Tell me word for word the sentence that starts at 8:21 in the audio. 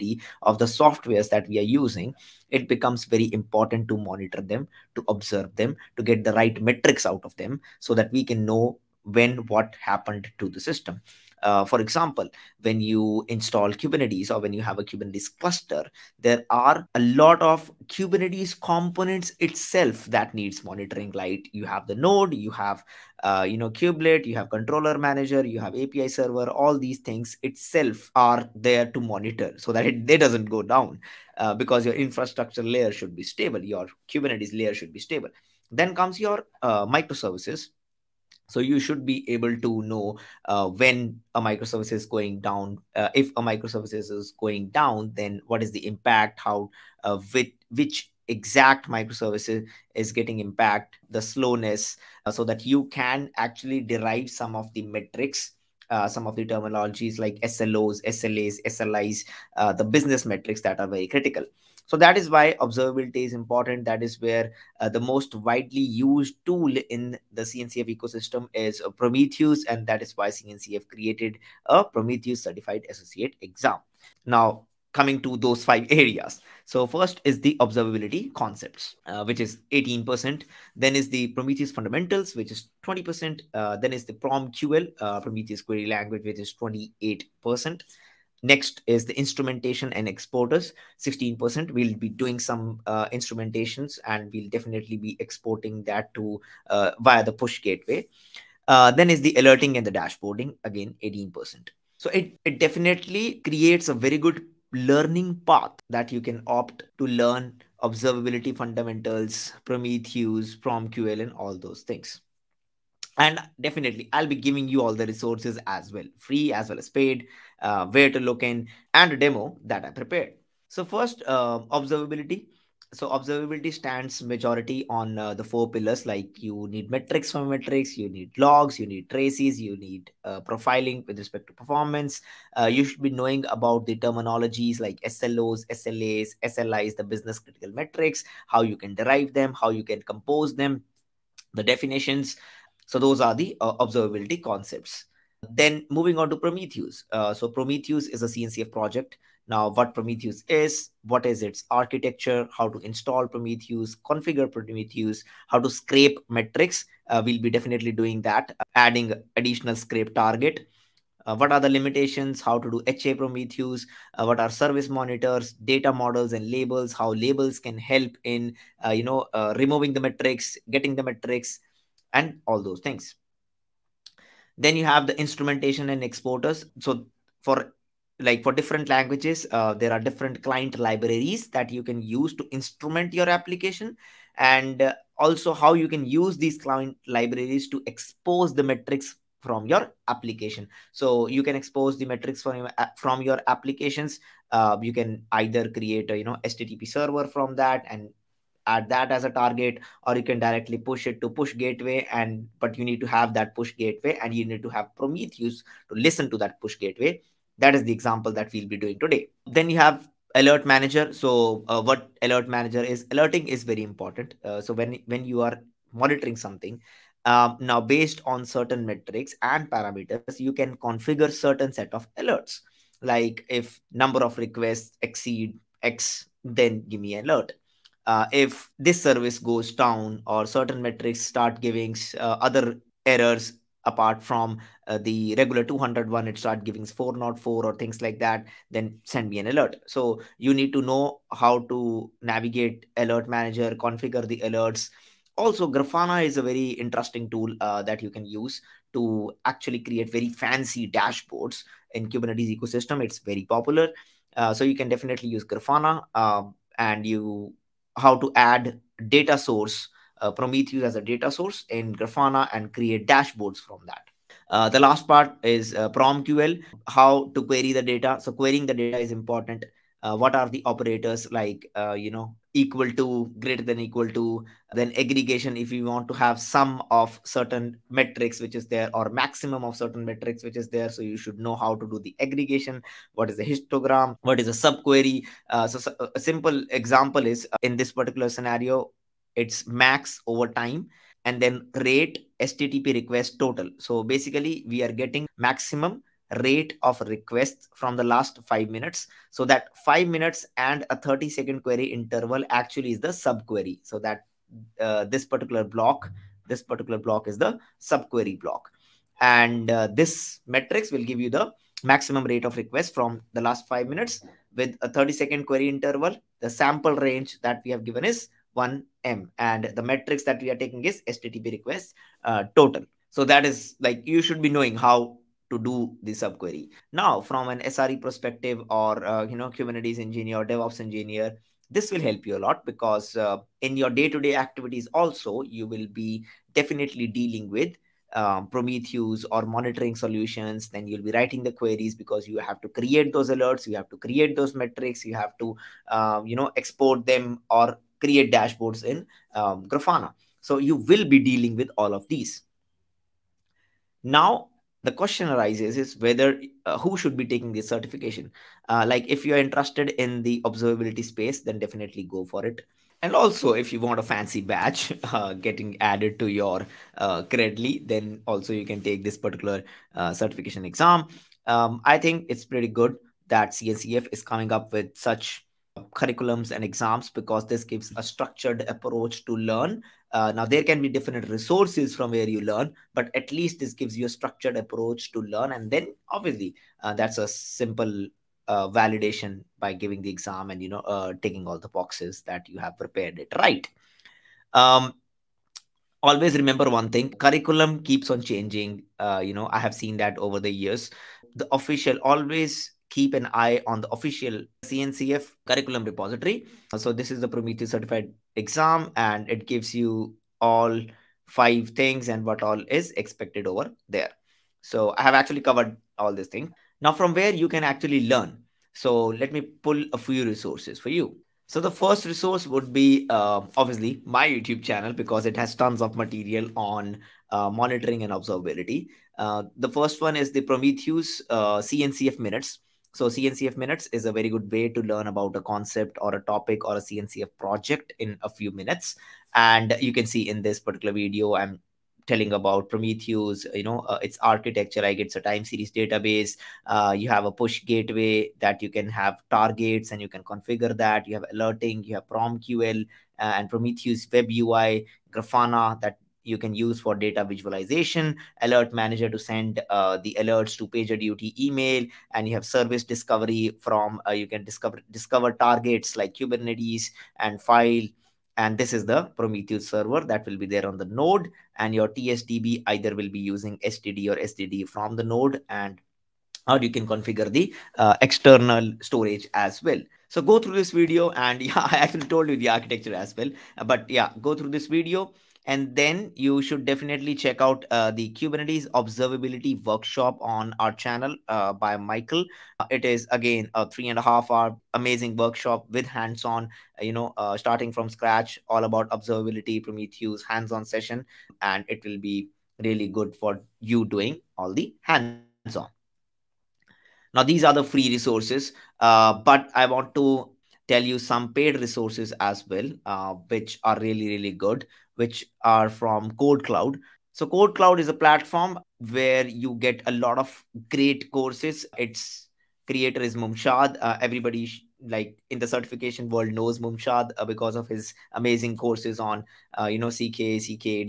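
And it will be really good for you doing all the hands on.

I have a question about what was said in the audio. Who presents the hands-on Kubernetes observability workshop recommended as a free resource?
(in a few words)
Michael.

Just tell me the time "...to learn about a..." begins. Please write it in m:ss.
7:14.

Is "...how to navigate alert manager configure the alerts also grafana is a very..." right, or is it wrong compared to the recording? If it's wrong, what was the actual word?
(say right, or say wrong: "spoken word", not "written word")
right.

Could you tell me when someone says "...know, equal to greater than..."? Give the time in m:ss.
4:32.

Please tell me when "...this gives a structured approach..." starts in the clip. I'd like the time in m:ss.
6:17.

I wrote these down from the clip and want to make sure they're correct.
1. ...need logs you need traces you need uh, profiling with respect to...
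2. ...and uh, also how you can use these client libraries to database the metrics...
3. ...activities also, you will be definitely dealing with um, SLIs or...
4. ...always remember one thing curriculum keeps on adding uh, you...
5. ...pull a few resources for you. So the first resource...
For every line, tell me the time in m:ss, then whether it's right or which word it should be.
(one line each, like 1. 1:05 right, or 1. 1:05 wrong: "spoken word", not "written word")
1. 2:08 right
2. 3:04 wrong: "expose", not "database"
3. 5:34 wrong: "Prometheus", not "SLIs"
4. 6:36 wrong: "changing", not "adding"
5. 6:59 right.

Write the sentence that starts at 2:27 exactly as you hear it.
Uh, so Prometheus is a CNCF project.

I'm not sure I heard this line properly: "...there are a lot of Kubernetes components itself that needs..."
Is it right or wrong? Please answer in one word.
right.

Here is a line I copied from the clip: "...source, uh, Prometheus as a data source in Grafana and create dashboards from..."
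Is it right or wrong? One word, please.
right.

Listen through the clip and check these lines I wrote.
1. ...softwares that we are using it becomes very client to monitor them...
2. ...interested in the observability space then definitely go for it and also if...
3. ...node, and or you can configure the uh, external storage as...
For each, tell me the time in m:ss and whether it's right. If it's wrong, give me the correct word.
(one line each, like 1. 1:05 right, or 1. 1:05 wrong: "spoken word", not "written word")
1. 0:00 wrong: "important", not "client"
2. 5:59 right
3. 7:55 right.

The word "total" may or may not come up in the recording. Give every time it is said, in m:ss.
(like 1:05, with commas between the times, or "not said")
4:53, 5:22.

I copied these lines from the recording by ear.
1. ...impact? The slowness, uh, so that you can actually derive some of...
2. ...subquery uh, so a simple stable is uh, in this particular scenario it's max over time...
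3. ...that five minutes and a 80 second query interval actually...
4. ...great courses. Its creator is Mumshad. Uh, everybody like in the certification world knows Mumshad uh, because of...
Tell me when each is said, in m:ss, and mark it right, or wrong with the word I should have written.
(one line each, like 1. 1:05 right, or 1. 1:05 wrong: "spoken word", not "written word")
1. 0:50 right
2. 4:44 wrong: "example", not "stable"
3. 4:59 wrong: "30", not "80"
4. 8:40 right.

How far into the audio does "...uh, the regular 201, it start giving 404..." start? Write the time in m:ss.
3:54.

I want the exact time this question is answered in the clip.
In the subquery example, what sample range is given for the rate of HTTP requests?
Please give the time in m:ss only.
5:18.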